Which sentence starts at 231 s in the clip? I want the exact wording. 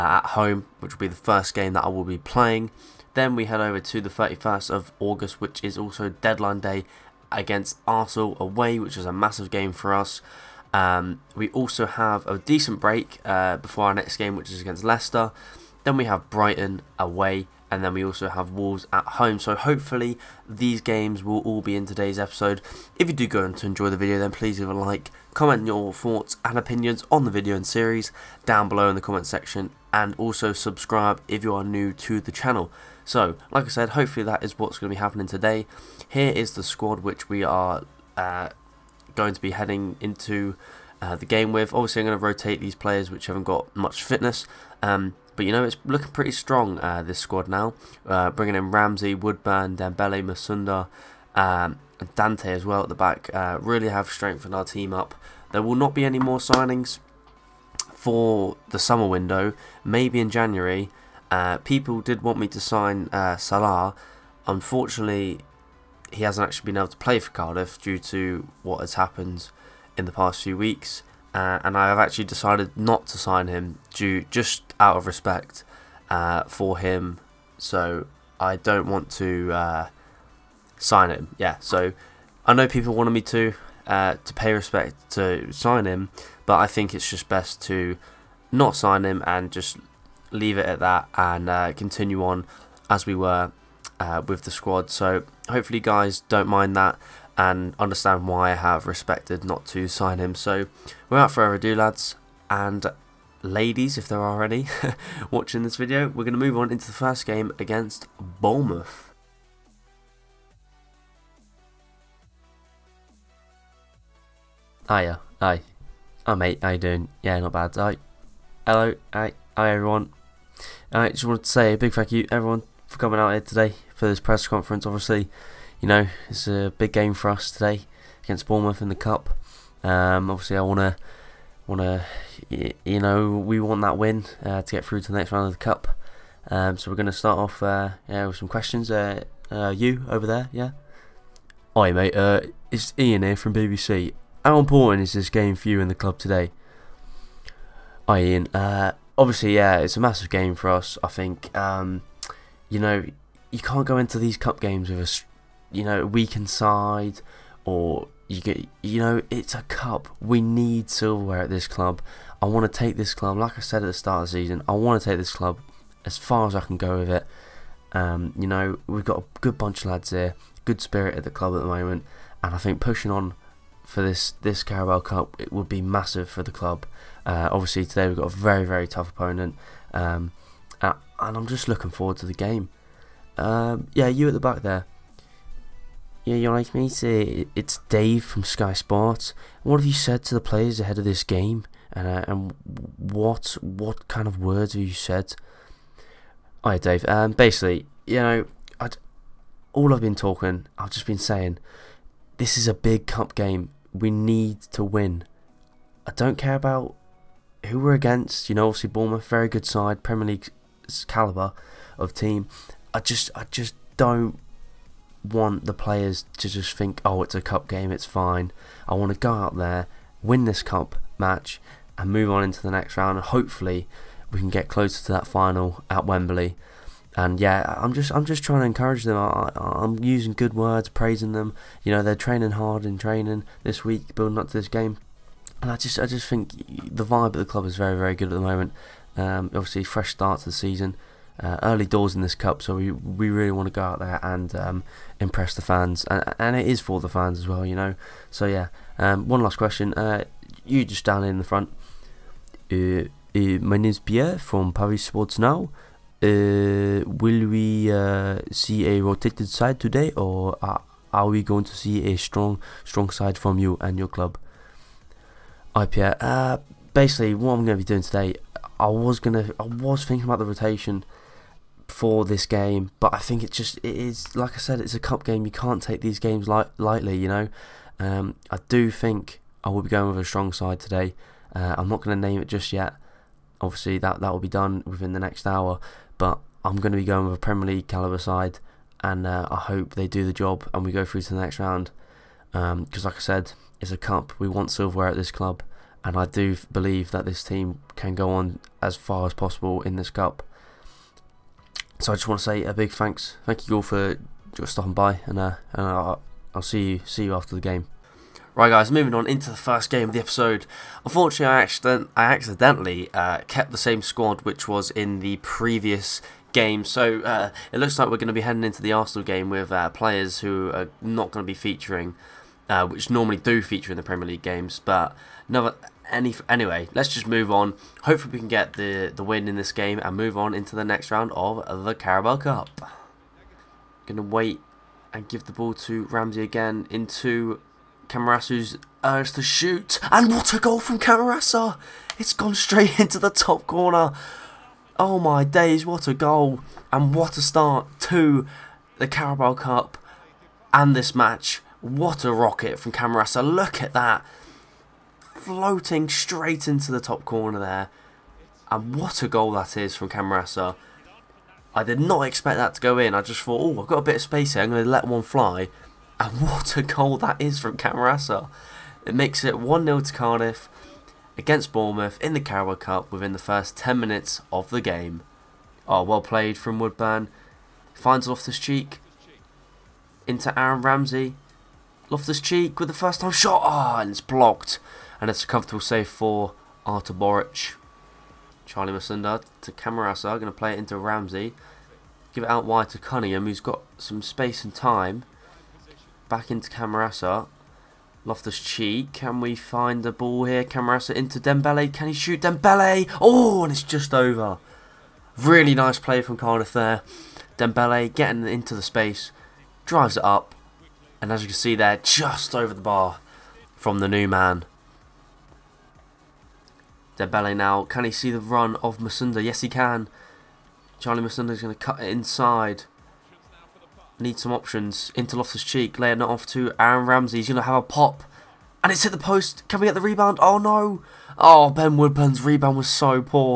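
You know, they're training hard in training this week, building up to this game.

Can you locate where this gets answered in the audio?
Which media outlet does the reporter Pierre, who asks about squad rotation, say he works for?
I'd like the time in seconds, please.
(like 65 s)
254 s.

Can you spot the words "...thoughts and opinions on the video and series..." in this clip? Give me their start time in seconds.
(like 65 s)
25 s.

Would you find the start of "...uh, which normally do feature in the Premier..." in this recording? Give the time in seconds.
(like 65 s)
322 s.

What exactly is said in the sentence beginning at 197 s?
Um, basically, you know, I'd, all I've been talking, I've just been saying, this is a big cup game.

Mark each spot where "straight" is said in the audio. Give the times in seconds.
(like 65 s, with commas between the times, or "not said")
342 s, 356 s.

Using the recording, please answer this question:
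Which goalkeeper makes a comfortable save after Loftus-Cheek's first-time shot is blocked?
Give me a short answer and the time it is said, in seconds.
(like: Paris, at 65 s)
Artur Boruc, at 386 s.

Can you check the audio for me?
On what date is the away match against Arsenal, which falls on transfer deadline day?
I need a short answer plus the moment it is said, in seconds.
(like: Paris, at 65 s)
31st of August, at 4 s.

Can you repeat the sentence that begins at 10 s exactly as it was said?
Um, we also have a decent break uh, before our next game, which is against Leicester.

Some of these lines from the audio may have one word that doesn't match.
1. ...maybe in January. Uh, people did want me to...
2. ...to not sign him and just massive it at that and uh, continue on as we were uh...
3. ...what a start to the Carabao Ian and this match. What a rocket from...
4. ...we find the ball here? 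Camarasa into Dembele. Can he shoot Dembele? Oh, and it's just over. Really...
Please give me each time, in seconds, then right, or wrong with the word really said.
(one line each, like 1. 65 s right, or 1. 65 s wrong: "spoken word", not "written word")
1. 59 s right
2. 87 s wrong: "leave", not "massive"
3. 347 s wrong: "Cup", not "Ian"
4. 399 s right.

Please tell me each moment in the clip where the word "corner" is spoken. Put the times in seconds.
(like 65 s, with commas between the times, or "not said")
343 s, 357 s.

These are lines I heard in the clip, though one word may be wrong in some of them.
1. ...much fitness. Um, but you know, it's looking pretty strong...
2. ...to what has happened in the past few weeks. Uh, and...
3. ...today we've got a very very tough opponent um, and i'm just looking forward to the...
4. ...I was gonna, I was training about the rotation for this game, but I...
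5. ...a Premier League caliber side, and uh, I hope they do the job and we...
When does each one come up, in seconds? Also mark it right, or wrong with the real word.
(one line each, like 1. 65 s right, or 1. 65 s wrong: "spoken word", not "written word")
1. 43 s right
2. 67 s right
3. 177 s right
4. 268 s wrong: "thinking", not "training"
5. 287 s right.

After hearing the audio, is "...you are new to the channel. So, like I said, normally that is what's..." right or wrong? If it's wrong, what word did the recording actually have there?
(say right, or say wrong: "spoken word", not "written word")
wrong: "hopefully", not "normally".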